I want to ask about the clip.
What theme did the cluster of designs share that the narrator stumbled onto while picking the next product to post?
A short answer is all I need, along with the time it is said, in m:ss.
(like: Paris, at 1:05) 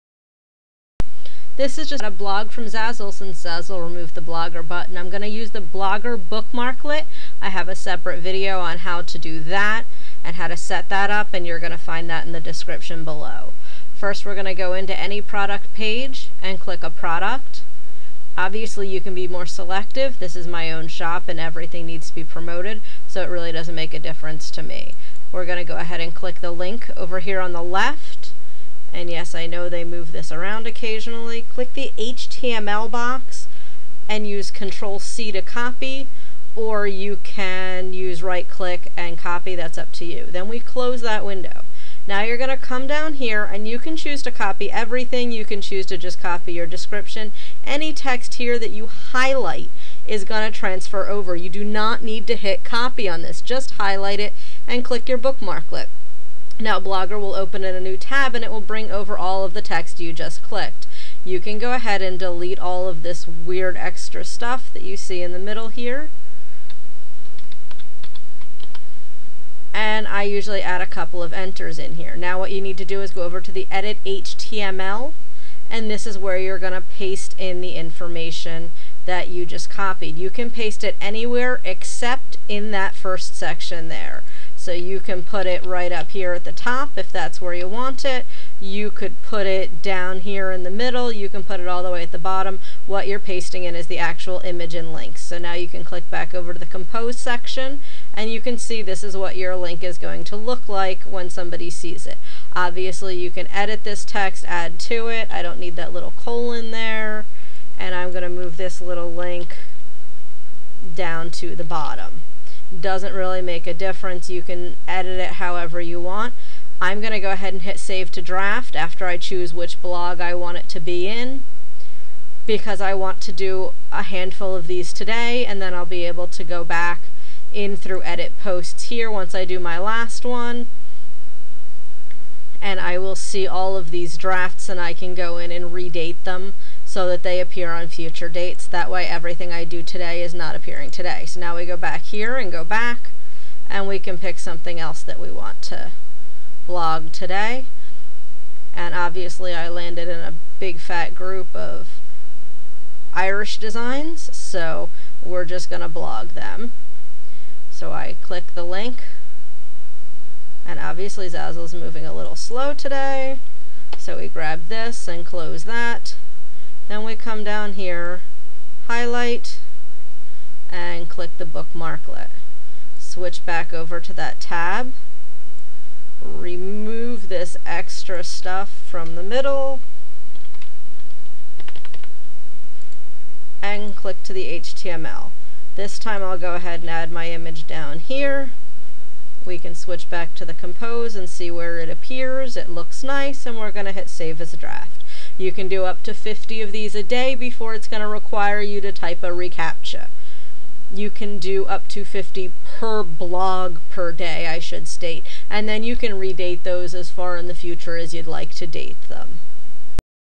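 Irish, at 2:33.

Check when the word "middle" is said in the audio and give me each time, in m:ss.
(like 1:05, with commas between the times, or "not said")
1:05, 1:30, 2:59.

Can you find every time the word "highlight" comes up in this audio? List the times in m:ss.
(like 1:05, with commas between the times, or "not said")
0:48, 0:53, 2:48.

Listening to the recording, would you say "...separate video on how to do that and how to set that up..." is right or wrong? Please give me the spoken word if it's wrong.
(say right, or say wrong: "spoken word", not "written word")
right.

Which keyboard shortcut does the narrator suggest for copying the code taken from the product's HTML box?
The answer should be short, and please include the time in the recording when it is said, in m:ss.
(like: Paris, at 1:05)
Control C, at 0:34.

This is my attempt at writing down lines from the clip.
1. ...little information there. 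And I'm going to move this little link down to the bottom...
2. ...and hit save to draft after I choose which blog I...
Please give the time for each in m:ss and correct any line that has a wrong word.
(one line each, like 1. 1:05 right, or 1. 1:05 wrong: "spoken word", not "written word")
1. 1:45 wrong: "colon", not "information"
2. 1:57 right.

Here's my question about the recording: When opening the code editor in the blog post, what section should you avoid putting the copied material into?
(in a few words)
first section.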